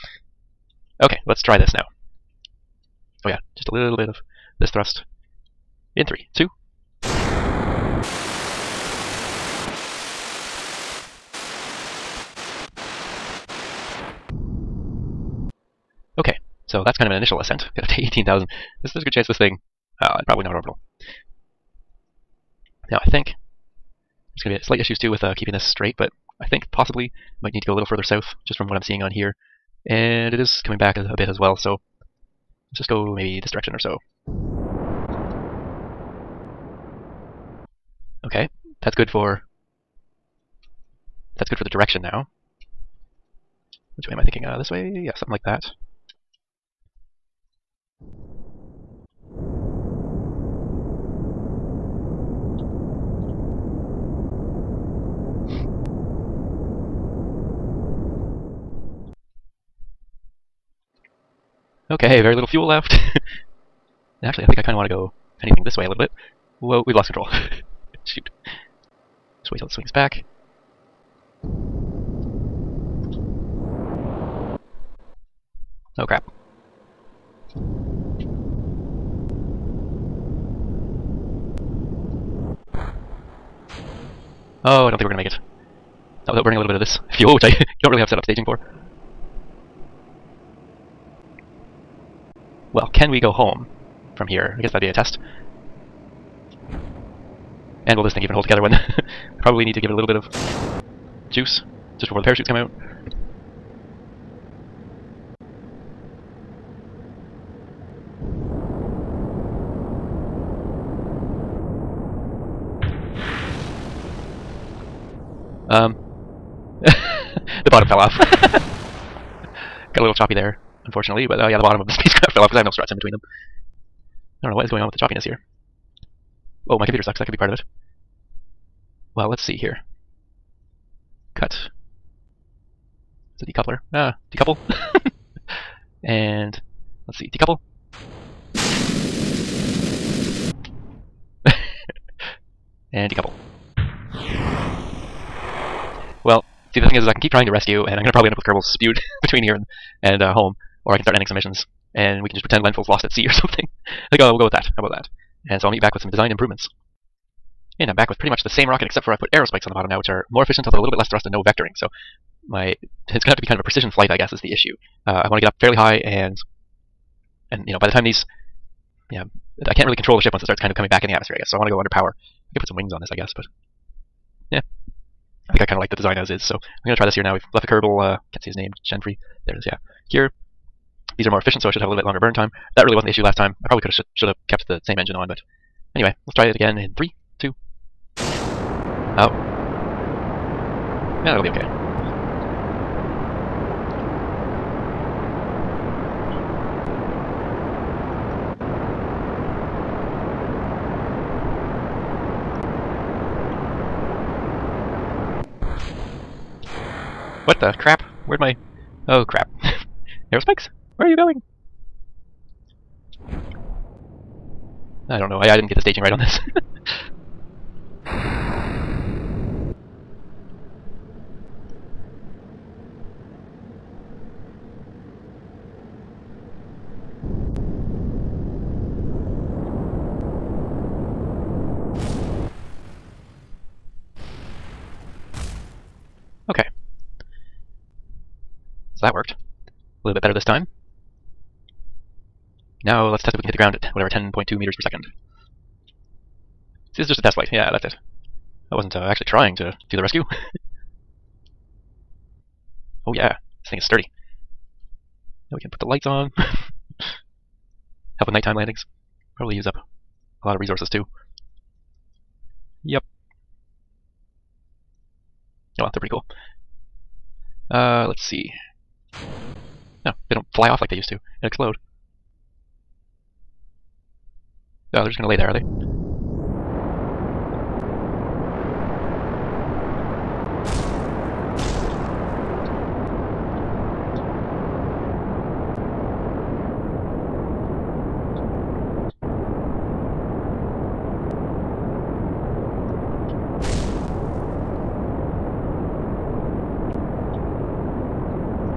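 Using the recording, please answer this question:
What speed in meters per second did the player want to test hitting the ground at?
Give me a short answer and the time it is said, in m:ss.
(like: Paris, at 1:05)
10.2 meters per second, at 4:04.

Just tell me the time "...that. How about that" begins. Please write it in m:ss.
2:34.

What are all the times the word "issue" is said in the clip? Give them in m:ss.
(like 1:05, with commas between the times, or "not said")
0:24, 2:44, 3:03.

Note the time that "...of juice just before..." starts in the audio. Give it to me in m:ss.
1:40.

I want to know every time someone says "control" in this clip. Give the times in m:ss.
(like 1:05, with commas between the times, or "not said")
1:07, 2:49.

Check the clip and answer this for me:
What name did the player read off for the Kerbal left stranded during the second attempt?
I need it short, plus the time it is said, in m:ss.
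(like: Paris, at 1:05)
Genfrey, at 2:58.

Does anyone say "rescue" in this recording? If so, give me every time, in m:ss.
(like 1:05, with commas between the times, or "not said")
2:27, 4:10.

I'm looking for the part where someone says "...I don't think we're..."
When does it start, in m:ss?
1:24.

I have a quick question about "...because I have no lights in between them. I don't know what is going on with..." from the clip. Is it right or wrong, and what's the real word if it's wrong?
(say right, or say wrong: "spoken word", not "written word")
wrong: "struts", not "lights".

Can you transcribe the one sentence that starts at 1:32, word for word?
Well, can we go home from here?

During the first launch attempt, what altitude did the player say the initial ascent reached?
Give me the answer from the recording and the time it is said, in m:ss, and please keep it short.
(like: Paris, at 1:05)
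18,000, at 0:17.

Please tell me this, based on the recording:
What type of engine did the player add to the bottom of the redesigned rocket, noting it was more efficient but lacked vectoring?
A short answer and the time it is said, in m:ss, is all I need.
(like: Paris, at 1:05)
Aerospikes, at 2:39.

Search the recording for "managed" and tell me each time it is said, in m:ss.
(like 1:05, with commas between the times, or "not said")
not said.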